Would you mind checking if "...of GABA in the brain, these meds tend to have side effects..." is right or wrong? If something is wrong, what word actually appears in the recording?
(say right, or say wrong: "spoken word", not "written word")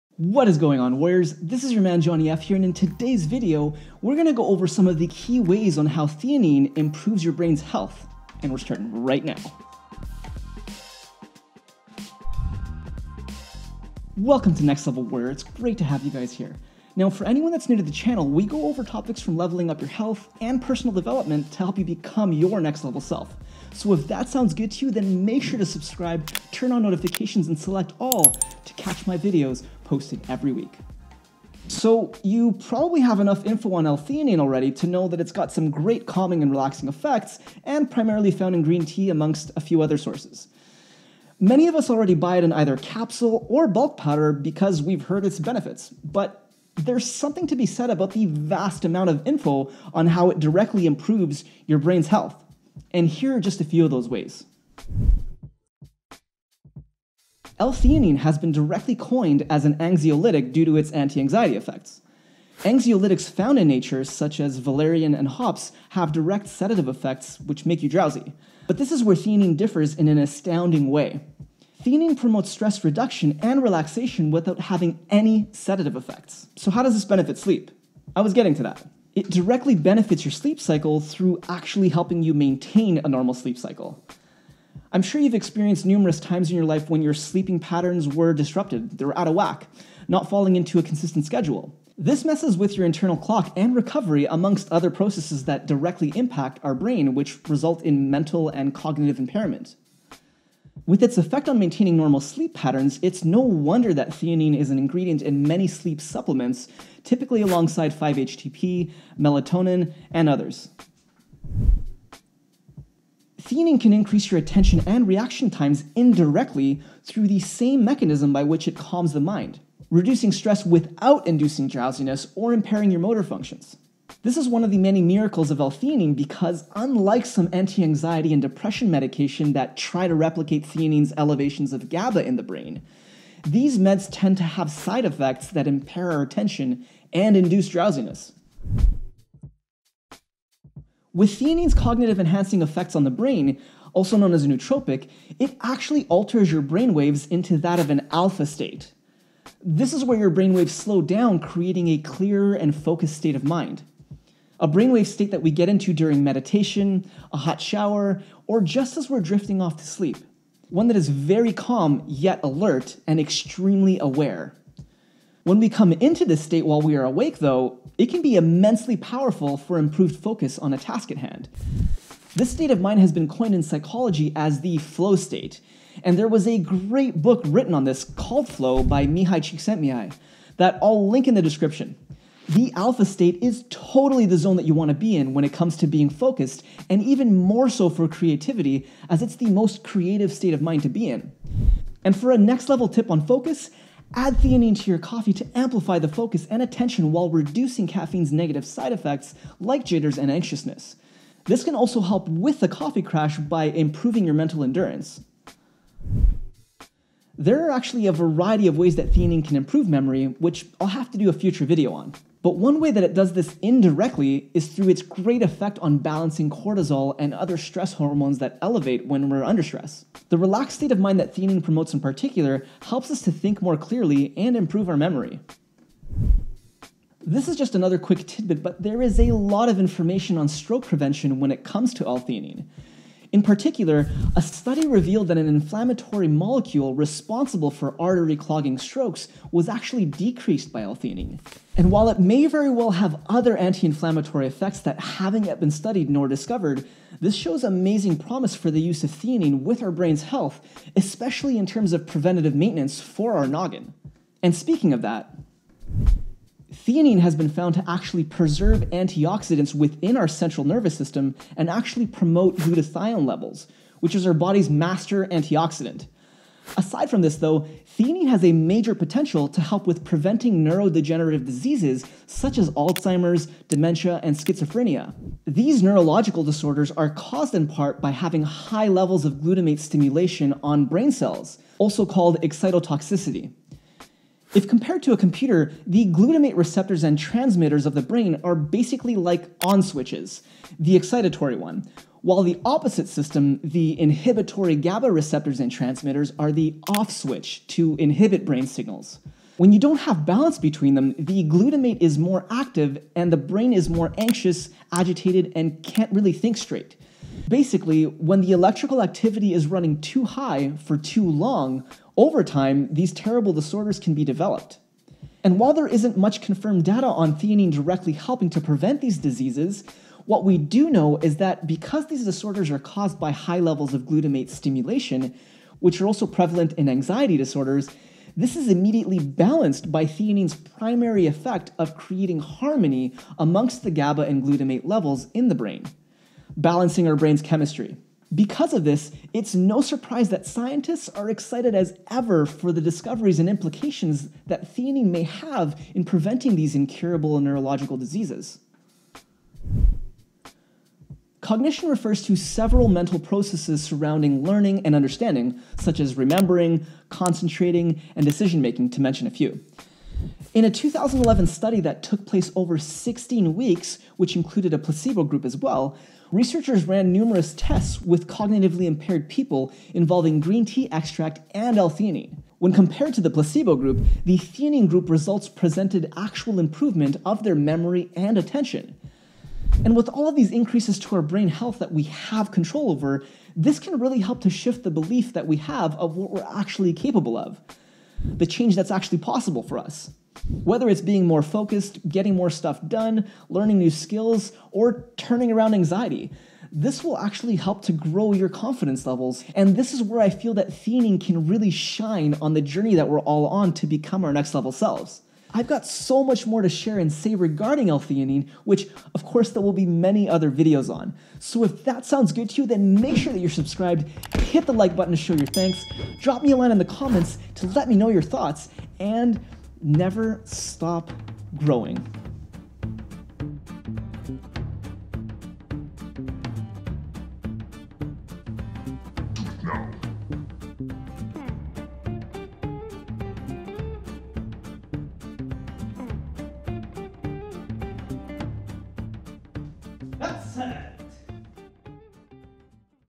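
right.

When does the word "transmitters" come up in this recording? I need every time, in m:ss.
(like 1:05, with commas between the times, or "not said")
4:47, 4:55.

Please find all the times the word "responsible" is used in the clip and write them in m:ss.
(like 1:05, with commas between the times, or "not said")
3:56.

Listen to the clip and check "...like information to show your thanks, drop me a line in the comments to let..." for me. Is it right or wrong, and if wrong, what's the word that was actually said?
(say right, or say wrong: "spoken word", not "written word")
wrong: "button", not "information".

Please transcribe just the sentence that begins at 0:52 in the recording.
And here are just a few of those ways.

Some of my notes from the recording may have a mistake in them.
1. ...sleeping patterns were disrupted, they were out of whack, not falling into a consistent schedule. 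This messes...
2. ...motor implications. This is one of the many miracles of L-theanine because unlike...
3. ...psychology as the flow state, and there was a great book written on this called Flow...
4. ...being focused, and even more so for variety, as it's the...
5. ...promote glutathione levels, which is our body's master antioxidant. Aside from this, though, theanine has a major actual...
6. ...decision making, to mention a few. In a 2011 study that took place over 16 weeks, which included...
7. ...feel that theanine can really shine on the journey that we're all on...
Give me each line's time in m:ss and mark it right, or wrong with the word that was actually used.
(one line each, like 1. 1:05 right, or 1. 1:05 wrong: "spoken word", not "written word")
1. 1:27 right
2. 2:03 wrong: "functions", not "implications"
3. 2:53 right
4. 3:05 wrong: "creativity", not "variety"
5. 4:22 wrong: "potential", not "actual"
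6. 5:58 right
7. 6:40 right.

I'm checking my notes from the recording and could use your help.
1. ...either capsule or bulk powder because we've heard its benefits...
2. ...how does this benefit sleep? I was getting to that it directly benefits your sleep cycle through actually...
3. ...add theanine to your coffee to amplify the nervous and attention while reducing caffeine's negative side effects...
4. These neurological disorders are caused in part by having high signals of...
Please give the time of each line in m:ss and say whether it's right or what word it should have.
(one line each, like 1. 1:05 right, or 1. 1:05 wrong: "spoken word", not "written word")
1. 0:42 right
2. 1:16 right
3. 3:14 wrong: "focus", not "nervous"
4. 4:35 wrong: "levels", not "signals".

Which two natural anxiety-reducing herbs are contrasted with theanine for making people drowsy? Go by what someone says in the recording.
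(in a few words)
valerian and hops.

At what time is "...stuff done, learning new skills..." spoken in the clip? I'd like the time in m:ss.
6:32.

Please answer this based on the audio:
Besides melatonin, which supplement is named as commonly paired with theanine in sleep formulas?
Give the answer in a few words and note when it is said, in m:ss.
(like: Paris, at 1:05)
5-HTP, at 1:47.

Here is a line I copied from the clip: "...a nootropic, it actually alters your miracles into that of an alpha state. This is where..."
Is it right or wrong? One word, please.
wrong.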